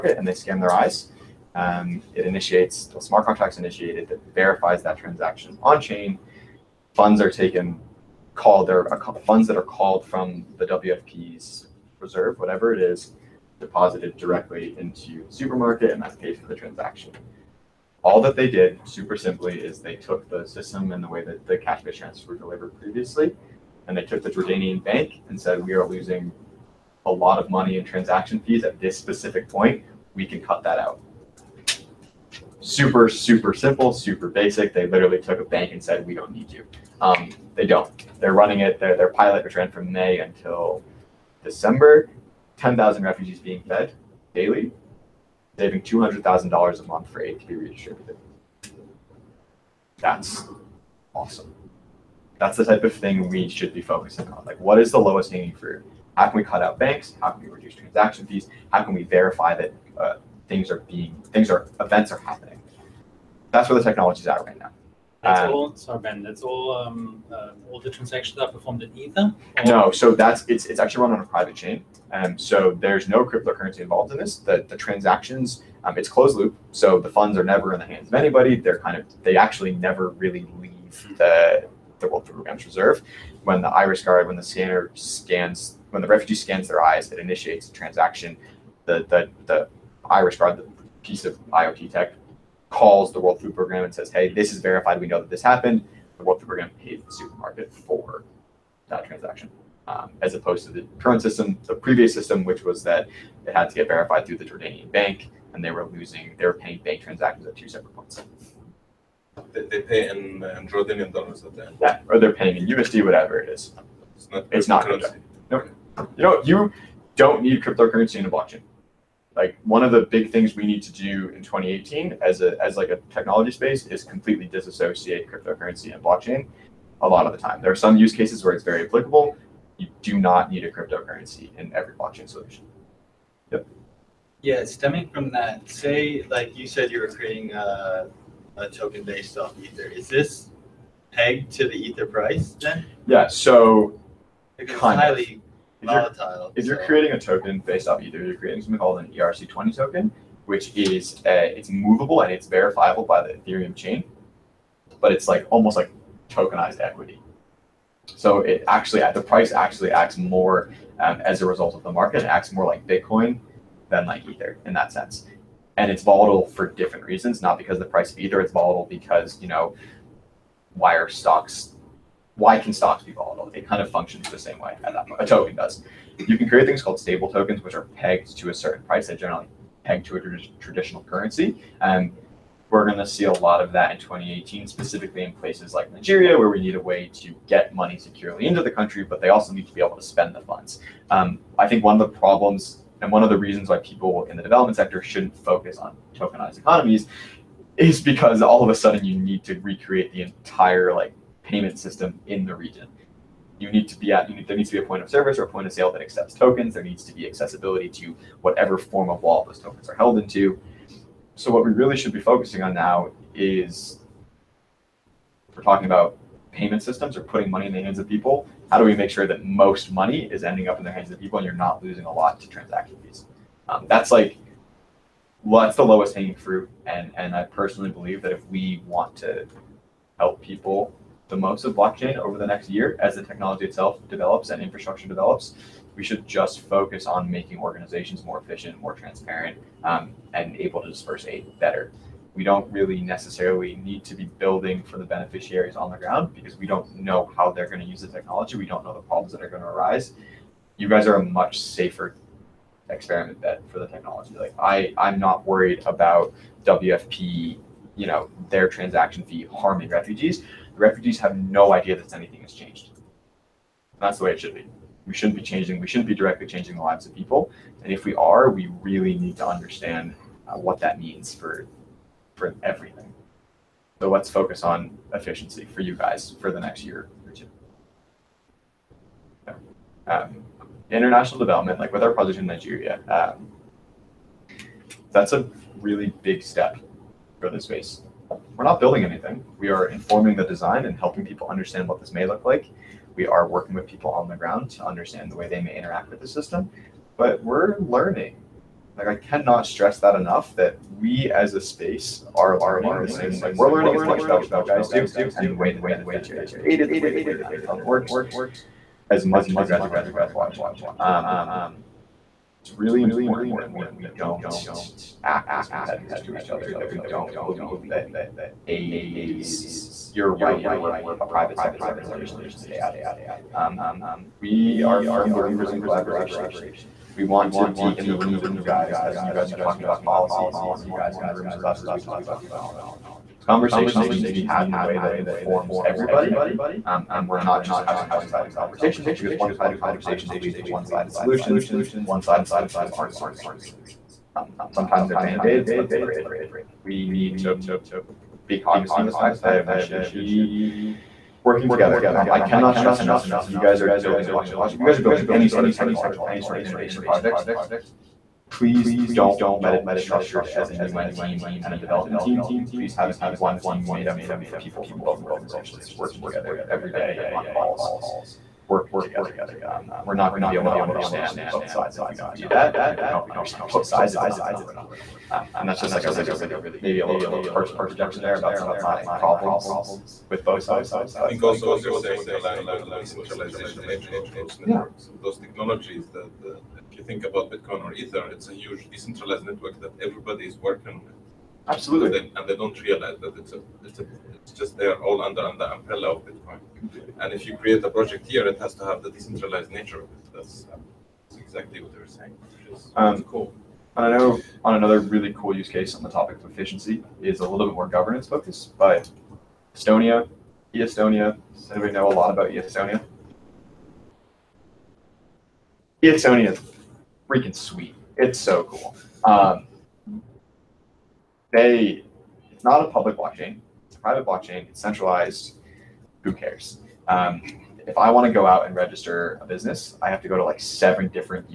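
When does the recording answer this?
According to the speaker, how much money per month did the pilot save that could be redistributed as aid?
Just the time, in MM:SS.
00:45.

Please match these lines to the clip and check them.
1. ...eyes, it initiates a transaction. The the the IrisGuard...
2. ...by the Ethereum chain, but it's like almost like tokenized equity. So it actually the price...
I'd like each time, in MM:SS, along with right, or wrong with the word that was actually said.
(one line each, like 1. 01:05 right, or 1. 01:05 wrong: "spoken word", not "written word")
1. 01:26 right
2. 02:33 right.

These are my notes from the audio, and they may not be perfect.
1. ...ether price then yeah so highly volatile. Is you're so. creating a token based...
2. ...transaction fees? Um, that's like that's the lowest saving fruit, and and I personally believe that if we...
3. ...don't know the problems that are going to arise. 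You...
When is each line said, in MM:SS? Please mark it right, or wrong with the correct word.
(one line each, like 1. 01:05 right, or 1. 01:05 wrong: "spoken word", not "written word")
1. 02:21 right
2. 03:42 wrong: "hanging", not "saving"
3. 04:08 right.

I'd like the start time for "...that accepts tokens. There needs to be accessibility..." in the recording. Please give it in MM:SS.
03:25.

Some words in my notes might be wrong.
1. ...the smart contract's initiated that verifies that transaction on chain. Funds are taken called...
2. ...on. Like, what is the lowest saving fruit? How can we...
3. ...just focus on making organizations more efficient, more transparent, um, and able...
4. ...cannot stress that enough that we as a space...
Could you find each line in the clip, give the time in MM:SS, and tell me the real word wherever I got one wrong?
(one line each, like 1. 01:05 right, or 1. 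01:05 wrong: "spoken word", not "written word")
1. 00:02 right
2. 00:54 wrong: "hanging", not "saving"
3. 03:56 right
4. 04:59 right.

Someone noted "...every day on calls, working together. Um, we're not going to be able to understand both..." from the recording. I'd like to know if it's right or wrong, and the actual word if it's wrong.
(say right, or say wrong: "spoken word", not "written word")
right.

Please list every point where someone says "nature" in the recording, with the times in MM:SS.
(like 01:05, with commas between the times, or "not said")
06:23, 06:39.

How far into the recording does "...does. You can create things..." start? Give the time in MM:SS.
02:55.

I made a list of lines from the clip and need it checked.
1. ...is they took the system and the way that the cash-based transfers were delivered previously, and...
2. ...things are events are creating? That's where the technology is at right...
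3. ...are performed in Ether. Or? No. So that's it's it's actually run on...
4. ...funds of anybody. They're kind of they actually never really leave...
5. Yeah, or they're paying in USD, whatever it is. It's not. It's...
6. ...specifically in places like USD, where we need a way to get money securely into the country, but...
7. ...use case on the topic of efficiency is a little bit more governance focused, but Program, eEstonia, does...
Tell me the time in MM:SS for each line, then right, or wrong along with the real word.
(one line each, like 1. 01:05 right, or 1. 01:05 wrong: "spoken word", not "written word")
1. 00:19 right
2. 01:01 wrong: "happening", not "creating"
3. 01:08 right
4. 01:17 wrong: "hands", not "funds"
5. 01:51 right
6. 03:04 wrong: "Nigeria", not "USD"
7. 06:45 wrong: "Estonia", not "Program".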